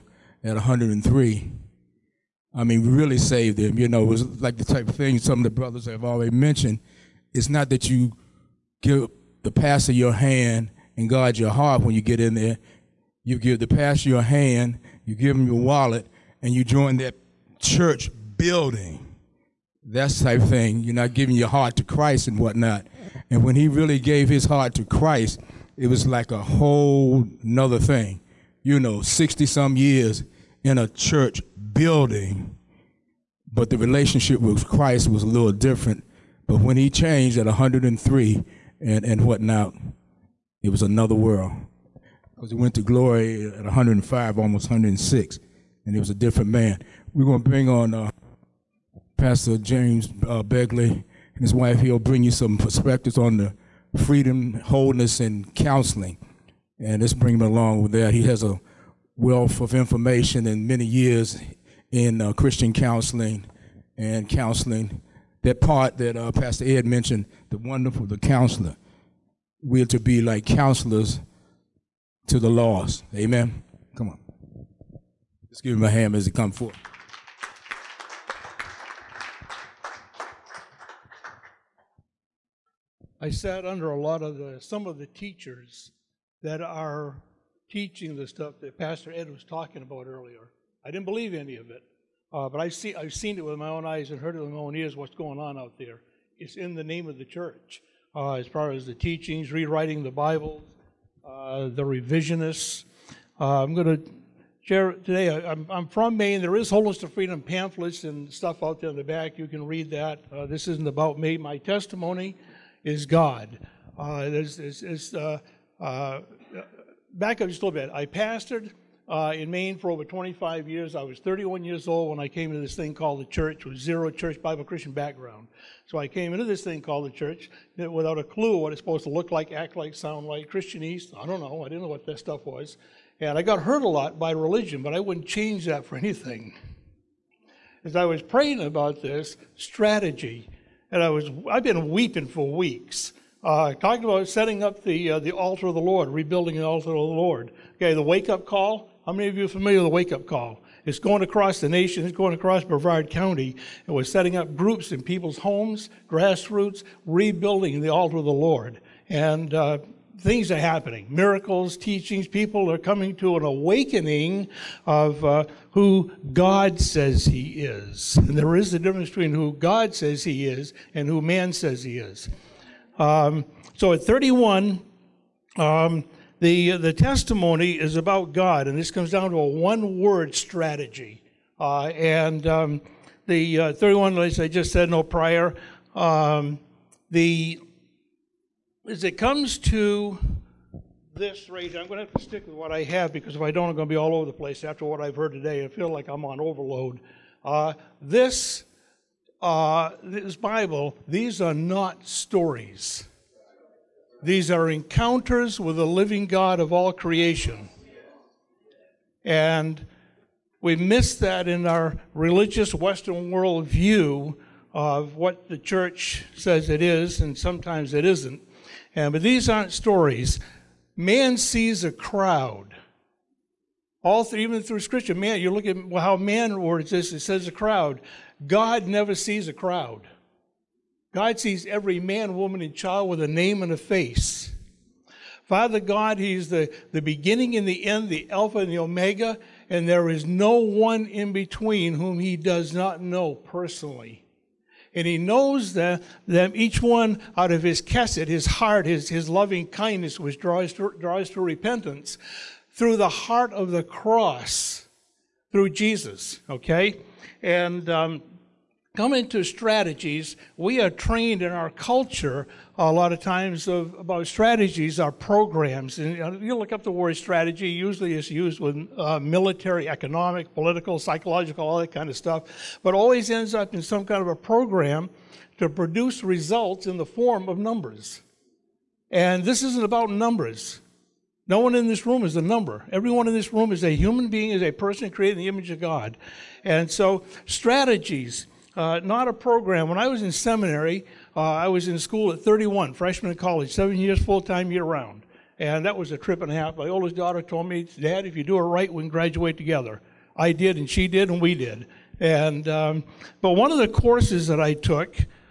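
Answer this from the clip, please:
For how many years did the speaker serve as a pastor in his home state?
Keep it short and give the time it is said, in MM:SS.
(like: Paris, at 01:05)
Over 25 years, at 01:59.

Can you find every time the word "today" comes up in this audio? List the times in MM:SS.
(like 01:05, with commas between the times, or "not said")
01:44, 03:15.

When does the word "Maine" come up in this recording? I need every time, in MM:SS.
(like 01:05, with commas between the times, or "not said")
01:46, 01:59.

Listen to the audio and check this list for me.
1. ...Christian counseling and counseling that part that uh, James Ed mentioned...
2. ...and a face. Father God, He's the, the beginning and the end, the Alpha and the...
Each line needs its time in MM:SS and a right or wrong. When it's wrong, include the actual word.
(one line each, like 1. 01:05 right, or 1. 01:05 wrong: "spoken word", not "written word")
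1. 01:02 wrong: "Pastor", not "James"
2. 03:53 right.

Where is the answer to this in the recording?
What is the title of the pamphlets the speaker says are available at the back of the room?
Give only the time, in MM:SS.
01:46.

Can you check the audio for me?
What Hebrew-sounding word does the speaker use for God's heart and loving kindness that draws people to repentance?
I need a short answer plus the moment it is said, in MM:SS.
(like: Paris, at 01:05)
Kesed, at 04:07.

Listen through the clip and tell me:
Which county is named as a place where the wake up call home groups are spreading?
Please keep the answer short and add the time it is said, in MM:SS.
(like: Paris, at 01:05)
Brevard County, at 02:32.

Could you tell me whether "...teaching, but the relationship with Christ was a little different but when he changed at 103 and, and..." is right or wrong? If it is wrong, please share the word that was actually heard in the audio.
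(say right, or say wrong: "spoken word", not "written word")
wrong: "building", not "teaching".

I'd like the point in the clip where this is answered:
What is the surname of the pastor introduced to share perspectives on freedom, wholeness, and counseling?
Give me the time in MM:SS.
00:50.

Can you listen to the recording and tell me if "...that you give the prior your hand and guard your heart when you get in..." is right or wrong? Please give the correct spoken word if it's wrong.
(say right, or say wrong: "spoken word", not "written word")
wrong: "pastor", not "prior".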